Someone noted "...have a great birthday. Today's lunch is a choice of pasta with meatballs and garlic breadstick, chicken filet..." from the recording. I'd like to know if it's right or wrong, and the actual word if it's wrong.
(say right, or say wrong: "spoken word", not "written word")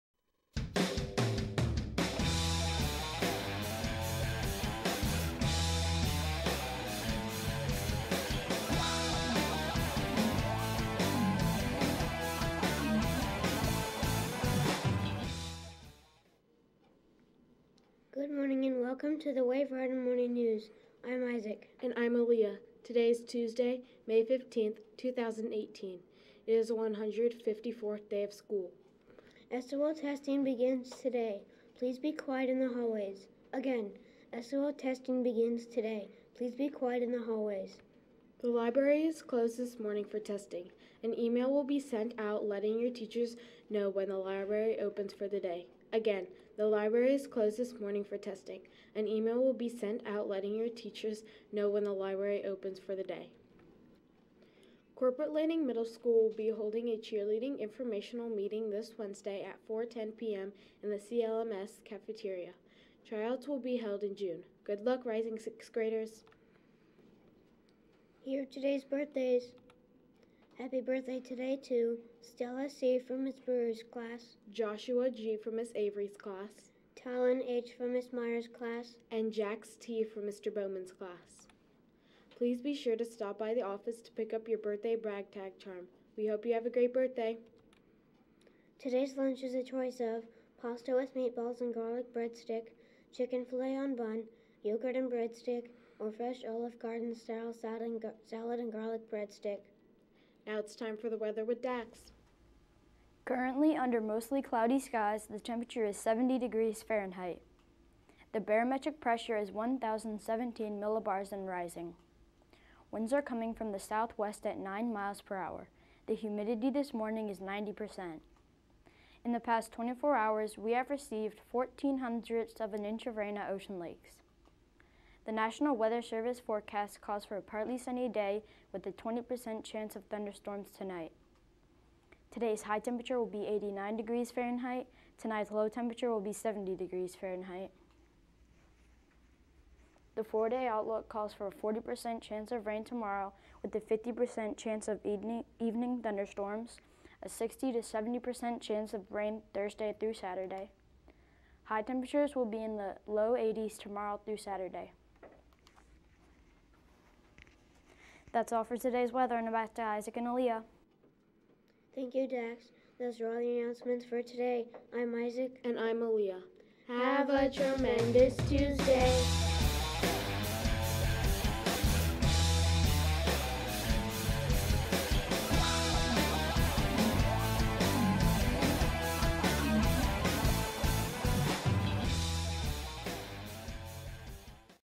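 right.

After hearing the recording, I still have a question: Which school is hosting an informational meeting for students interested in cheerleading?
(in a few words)
Corporate Landing Middle School.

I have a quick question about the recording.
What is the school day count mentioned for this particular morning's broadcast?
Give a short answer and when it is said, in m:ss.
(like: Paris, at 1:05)
154th, at 0:26.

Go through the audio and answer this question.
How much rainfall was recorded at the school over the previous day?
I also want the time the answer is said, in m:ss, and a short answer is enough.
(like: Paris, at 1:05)
14 hundredths of an inch, at 2:01.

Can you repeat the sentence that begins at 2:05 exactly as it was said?
The National Weather Service forecast calls for a partly sunny day with a 20% chance of thunderstorms tonight.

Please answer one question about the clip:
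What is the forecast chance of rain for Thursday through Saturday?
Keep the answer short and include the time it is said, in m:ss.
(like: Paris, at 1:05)
60 to 70%, at 2:27.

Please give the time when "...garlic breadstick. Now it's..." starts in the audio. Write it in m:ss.
1:38.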